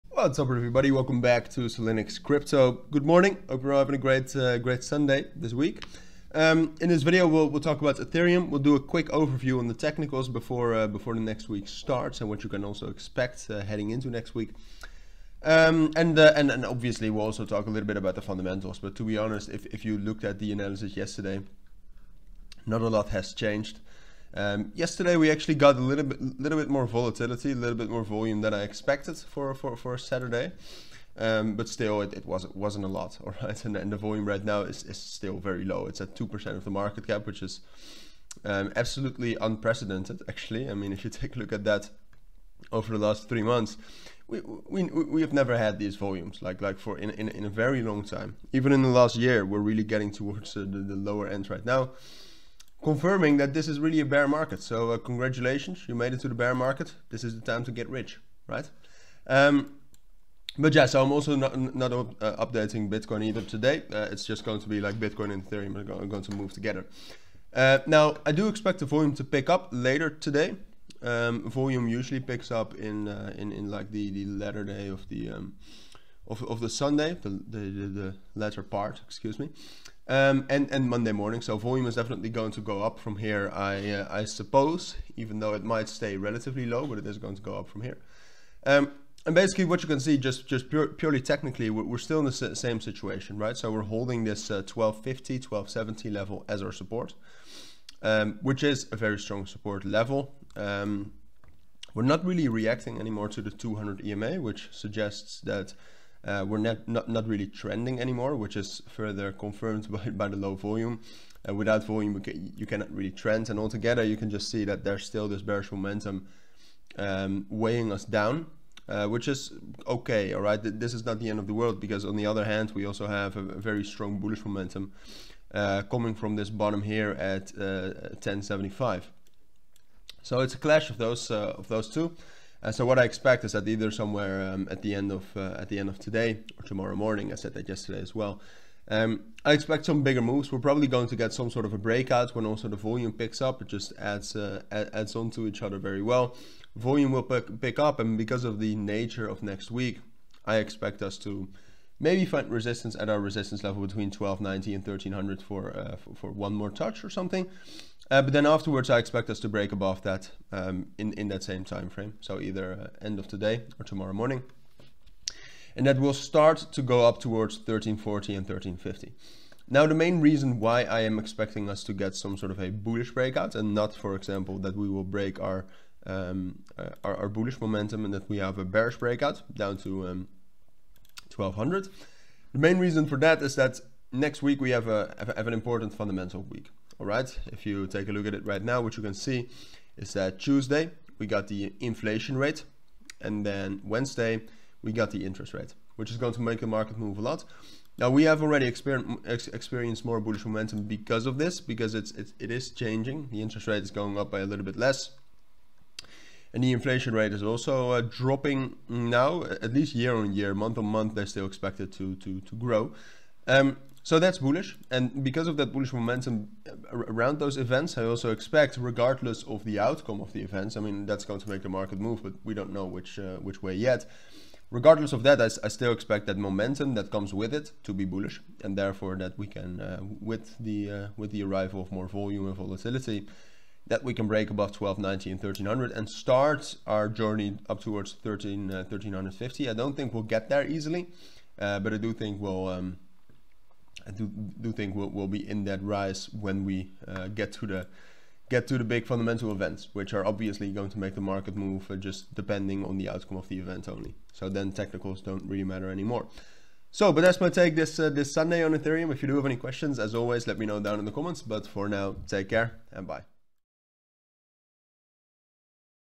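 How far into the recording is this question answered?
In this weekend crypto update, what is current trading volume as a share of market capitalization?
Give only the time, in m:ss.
0:36.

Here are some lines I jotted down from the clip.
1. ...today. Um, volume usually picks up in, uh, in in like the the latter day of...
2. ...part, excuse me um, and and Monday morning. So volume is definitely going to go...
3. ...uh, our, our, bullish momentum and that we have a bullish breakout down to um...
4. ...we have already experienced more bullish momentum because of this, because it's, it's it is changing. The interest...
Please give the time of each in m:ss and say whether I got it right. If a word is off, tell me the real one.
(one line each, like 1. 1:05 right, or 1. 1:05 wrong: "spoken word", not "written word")
1. 1:10 right
2. 1:18 right
3. 2:56 wrong: "bearish", not "bullish"
4. 3:18 right.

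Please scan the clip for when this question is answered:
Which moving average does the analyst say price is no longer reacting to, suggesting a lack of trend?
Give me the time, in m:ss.
1:43.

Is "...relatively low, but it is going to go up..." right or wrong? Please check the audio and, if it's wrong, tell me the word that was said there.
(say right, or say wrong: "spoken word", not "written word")
right.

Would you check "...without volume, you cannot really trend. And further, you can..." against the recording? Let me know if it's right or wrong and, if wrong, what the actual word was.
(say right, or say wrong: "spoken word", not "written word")
wrong: "altogether", not "further".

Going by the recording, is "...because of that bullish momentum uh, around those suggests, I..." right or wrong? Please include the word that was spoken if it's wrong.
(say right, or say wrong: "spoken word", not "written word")
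wrong: "events", not "suggests".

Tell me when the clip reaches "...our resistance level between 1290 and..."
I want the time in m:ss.
2:33.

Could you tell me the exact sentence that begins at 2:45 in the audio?
And that will start to go up towards 1340 and 1350.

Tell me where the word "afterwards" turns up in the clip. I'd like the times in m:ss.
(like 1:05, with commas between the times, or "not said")
2:38.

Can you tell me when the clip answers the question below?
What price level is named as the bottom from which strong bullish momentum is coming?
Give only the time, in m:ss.
2:08.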